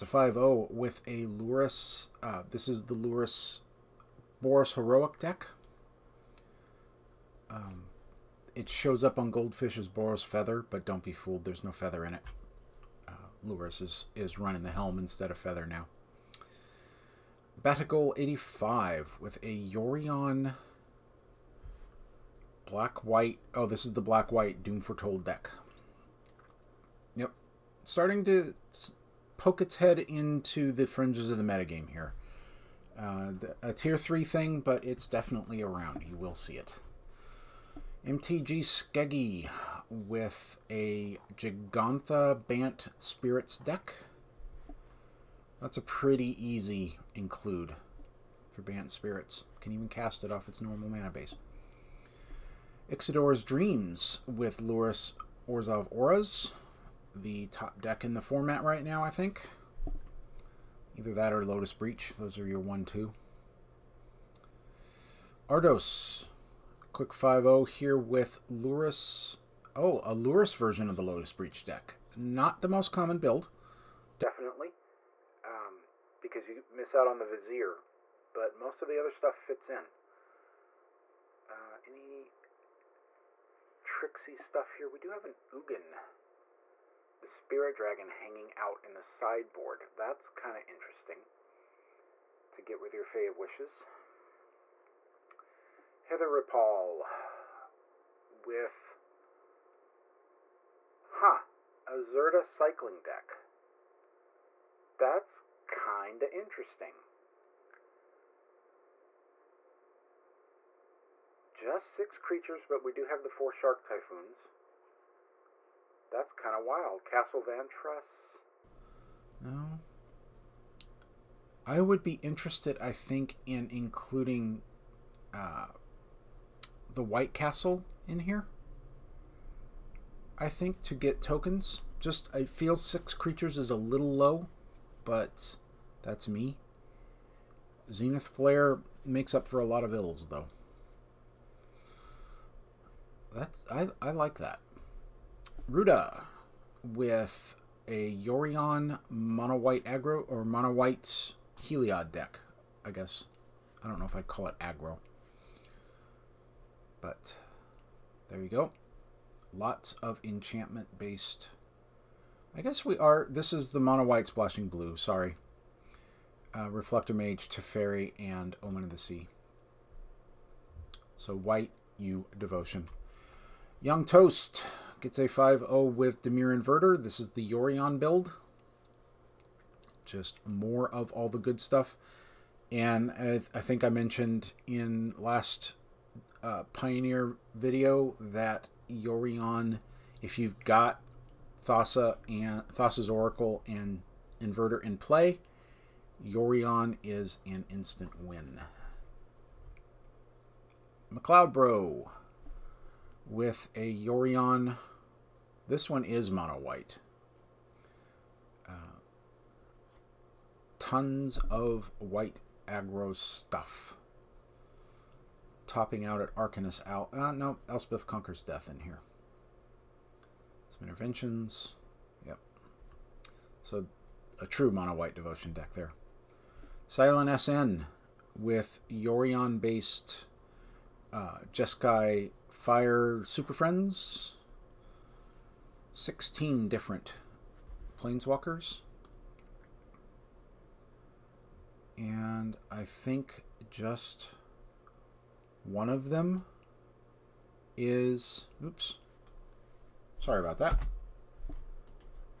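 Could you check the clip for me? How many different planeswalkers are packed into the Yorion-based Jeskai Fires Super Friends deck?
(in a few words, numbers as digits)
16.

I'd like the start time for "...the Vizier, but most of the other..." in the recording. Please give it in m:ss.
1:17.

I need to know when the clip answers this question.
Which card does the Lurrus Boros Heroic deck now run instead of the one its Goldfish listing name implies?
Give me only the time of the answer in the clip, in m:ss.
0:14.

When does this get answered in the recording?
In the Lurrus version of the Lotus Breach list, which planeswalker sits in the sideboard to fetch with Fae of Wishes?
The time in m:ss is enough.
1:25.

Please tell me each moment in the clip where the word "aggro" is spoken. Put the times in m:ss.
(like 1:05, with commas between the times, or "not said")
2:29, 2:34, 3:32.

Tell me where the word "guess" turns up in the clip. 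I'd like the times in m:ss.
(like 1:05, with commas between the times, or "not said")
2:32, 2:42.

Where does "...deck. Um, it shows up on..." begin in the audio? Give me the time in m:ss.
0:05.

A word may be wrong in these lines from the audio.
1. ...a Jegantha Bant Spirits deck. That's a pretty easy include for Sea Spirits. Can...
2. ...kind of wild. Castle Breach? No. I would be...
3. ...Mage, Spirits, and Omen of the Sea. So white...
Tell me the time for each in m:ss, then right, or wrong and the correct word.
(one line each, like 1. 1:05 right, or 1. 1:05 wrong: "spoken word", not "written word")
1. 0:40 wrong: "Bant", not "Sea"
2. 1:56 wrong: "Vantress", not "Breach"
3. 2:47 wrong: "Teferi", not "Spirits".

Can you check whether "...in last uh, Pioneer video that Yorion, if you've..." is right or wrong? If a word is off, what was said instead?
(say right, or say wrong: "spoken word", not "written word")
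right.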